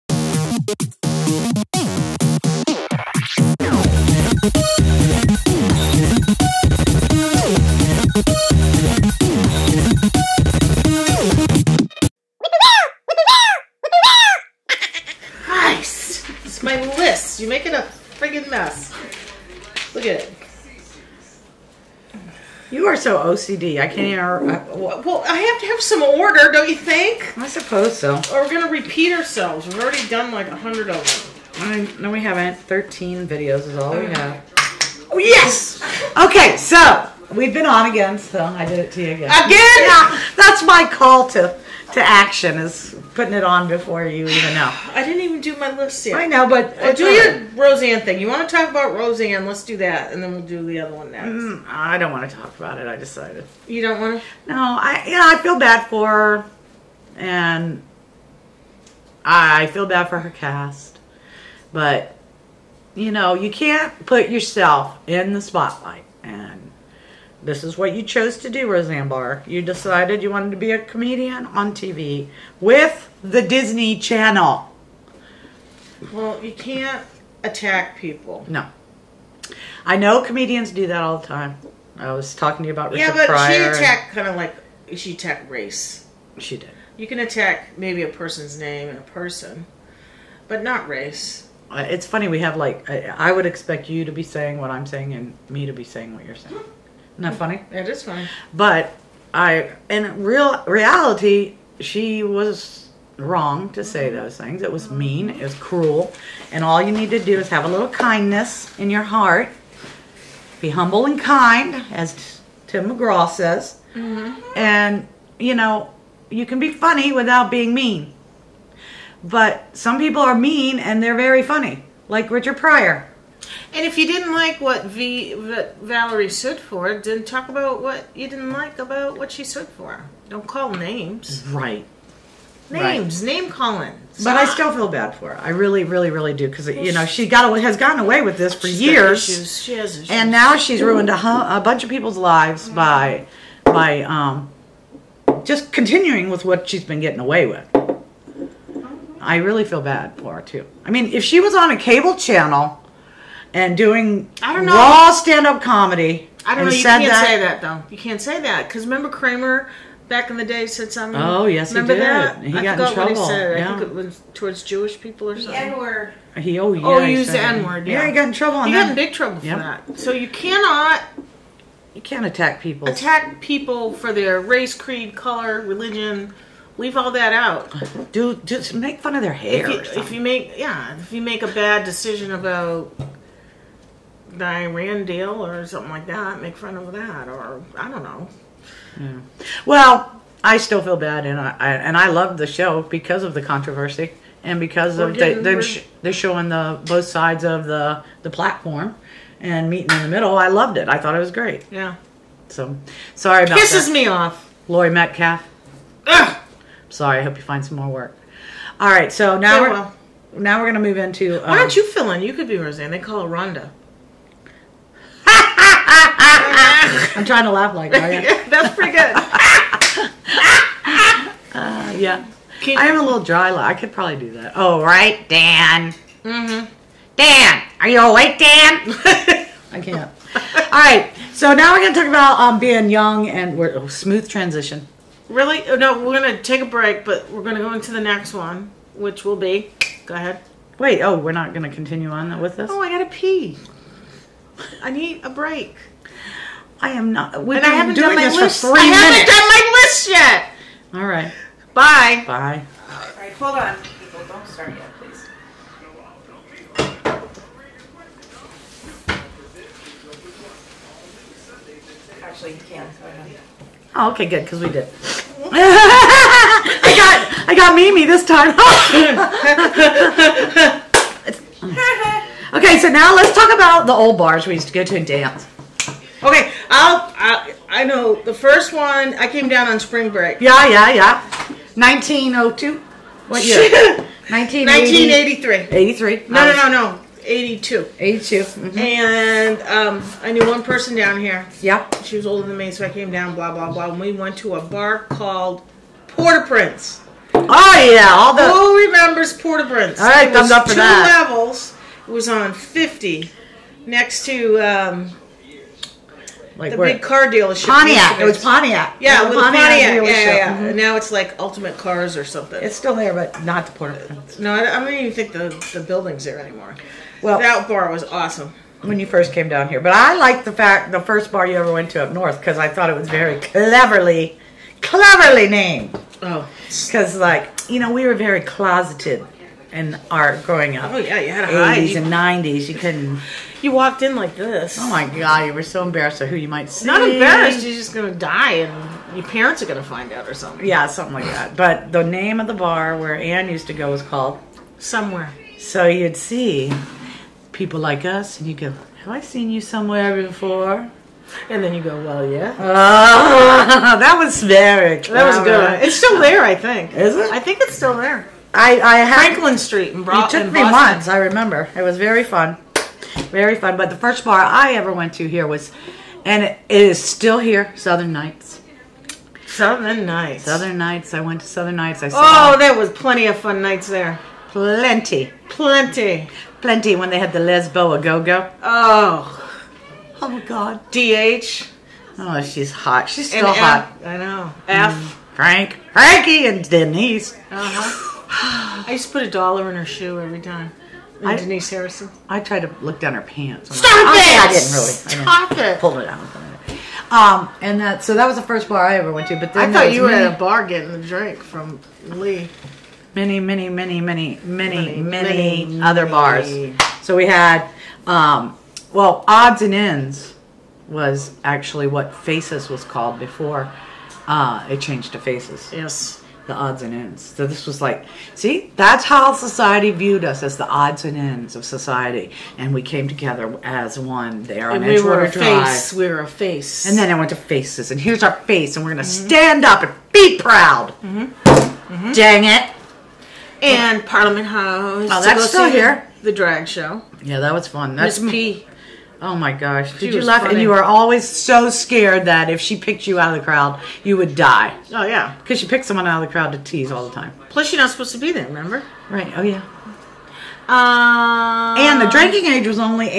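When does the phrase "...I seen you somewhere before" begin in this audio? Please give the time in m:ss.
5:49.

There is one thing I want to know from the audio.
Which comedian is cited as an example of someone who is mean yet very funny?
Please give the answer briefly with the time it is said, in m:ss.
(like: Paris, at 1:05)
Richard Pryor, at 2:02.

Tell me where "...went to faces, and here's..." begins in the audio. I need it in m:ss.
7:07.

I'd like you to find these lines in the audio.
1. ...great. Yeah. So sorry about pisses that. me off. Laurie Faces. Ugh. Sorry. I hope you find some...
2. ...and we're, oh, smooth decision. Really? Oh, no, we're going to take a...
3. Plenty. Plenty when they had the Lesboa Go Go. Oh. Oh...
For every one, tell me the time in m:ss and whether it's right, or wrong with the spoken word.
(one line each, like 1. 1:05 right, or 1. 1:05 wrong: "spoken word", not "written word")
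1. 3:21 wrong: "Metcalf", not "Faces"
2. 3:53 wrong: "transition", not "decision"
3. 6:15 right.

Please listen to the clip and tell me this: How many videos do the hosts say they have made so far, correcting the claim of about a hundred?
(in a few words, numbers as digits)
13.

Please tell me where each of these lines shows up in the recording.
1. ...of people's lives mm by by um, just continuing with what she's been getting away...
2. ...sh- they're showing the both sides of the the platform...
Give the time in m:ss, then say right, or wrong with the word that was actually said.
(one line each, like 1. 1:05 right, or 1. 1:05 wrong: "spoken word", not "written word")
1. 2:21 right
2. 3:15 right.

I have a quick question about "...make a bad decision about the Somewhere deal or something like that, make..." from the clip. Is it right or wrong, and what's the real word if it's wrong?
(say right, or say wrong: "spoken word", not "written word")
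wrong: "Iran", not "Somewhere".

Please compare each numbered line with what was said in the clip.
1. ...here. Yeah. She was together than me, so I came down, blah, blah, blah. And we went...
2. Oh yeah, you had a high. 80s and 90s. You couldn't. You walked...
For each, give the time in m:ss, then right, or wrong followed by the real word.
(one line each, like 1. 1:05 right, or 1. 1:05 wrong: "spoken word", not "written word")
1. 4:51 wrong: "older", not "together"
2. 5:30 right.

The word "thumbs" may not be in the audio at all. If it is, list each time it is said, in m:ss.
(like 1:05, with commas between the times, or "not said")
5:00.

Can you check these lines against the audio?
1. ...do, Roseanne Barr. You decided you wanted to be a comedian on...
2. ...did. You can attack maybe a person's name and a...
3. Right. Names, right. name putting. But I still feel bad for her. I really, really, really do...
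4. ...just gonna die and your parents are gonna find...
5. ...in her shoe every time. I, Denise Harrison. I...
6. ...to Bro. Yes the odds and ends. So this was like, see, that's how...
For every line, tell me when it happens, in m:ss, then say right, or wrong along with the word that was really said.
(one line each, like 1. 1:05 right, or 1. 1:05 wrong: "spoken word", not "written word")
1. 1:08 right
2. 1:26 right
3. 2:11 wrong: "calling", not "putting"
4. 5:37 right
5. 6:29 right
6. 6:55 wrong: "Faces", not "Bro".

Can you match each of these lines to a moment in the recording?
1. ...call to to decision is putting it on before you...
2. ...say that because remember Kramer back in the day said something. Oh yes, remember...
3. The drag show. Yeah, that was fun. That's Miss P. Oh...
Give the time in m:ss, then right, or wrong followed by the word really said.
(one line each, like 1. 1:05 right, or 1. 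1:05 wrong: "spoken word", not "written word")
1. 0:40 wrong: "action", not "decision"
2. 2:38 right
3. 7:16 right.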